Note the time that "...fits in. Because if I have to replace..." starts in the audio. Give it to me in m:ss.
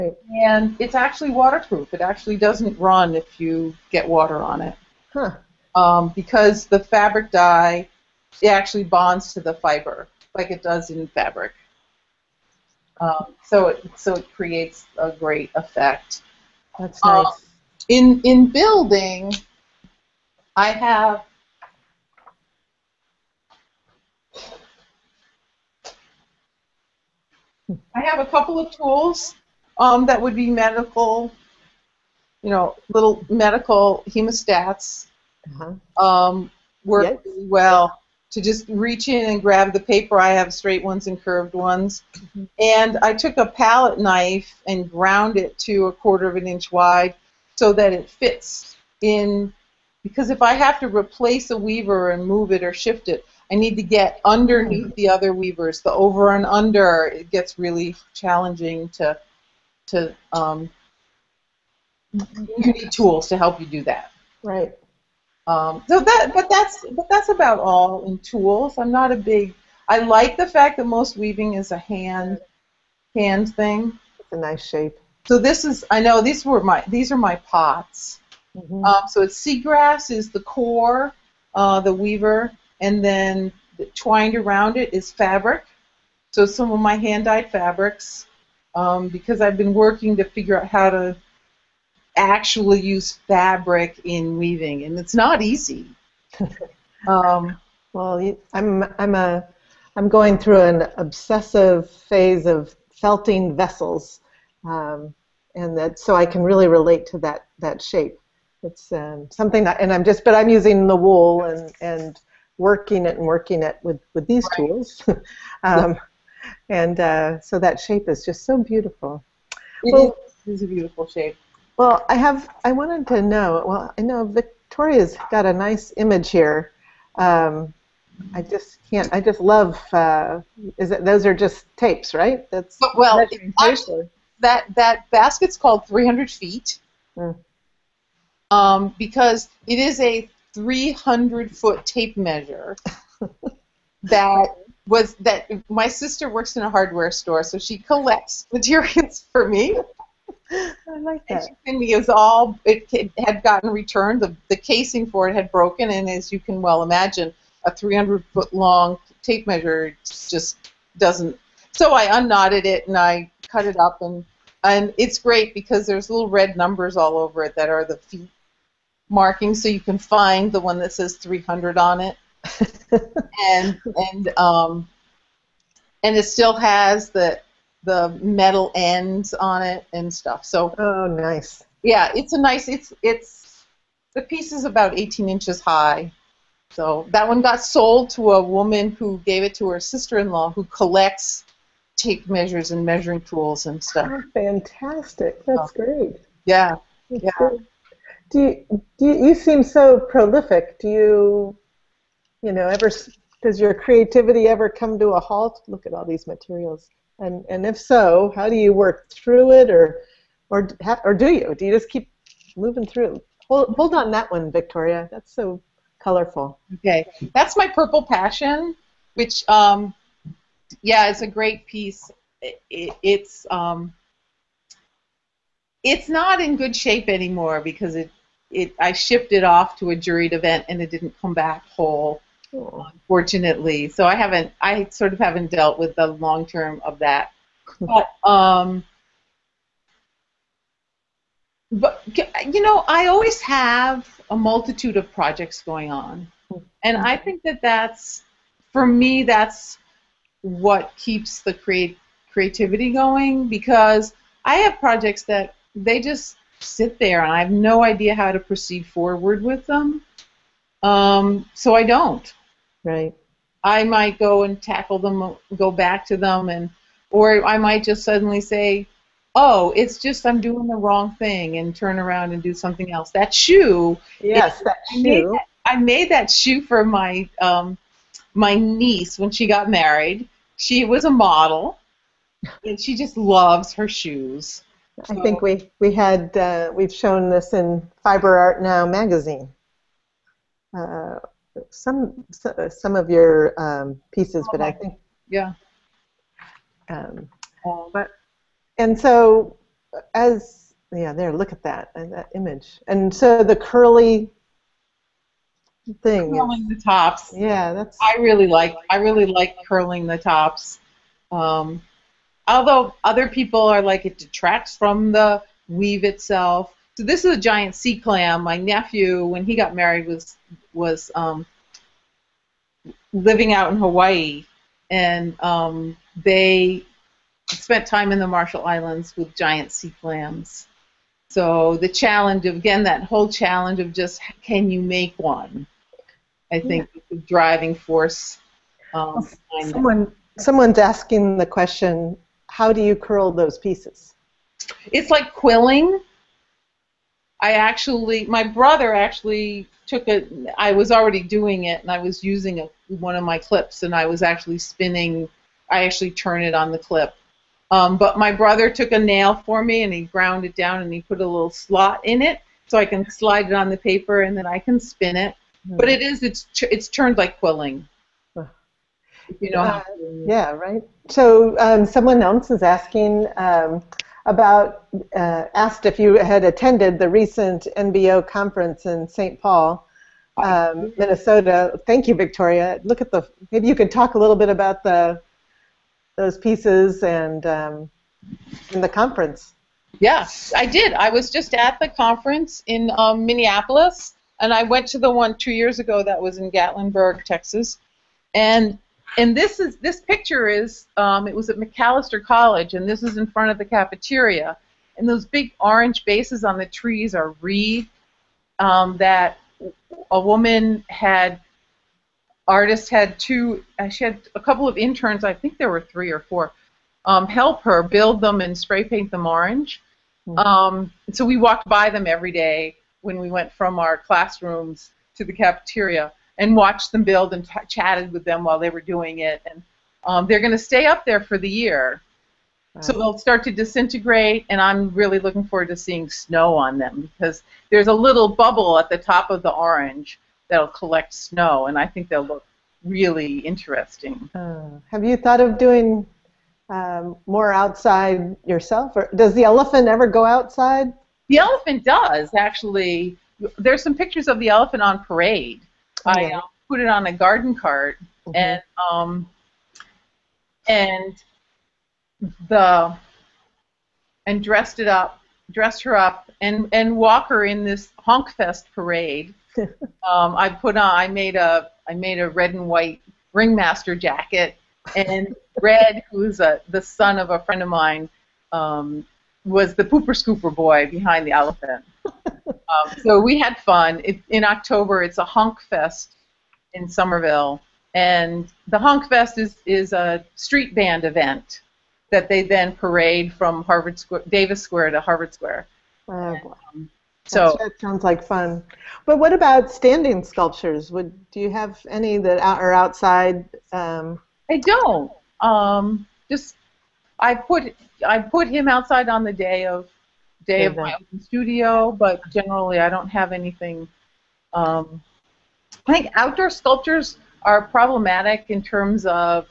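0:48.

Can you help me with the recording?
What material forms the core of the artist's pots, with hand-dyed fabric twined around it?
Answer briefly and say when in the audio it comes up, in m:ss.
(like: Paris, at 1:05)
Seagrass, at 1:19.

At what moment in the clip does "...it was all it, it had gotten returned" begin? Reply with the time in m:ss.
2:31.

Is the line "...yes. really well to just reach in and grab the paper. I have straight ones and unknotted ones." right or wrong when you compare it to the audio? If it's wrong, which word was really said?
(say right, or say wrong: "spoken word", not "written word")
wrong: "curved", not "unknotted".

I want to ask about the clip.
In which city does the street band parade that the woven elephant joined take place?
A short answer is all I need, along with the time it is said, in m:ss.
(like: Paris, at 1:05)
Somerville, at 8:06.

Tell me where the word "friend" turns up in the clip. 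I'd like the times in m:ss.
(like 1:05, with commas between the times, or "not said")
7:57.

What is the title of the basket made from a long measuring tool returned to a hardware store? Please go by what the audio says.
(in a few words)
300 feet.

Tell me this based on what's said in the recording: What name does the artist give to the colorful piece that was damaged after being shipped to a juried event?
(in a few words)
Purple passion.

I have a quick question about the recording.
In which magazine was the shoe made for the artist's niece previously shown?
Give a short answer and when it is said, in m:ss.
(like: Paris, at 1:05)
Fiber Art Now, at 4:48.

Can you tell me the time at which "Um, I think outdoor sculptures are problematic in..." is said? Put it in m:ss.
8:34.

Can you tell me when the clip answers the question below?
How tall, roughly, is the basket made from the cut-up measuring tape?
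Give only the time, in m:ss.
3:04.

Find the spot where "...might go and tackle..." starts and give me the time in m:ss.
4:23.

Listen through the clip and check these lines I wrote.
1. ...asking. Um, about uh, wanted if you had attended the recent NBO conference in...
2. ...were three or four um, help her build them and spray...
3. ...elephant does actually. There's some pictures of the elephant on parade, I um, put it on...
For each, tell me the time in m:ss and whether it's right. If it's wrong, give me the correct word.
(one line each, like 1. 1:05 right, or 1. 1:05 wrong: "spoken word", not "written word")
1. 6:12 wrong: "asked", not "wanted"
2. 6:55 right
3. 7:31 right.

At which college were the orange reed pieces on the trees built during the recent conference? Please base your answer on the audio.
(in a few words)
Macalester College.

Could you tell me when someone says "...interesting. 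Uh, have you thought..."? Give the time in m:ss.
7:23.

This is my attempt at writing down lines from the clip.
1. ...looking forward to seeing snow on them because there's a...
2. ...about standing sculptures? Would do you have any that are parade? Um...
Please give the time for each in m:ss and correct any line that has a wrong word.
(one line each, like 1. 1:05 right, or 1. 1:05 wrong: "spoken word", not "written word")
1. 7:15 right
2. 8:19 wrong: "outside", not "parade".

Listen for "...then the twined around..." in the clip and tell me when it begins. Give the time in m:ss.
1:23.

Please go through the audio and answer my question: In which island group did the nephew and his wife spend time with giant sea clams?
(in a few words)
Marshall Islands.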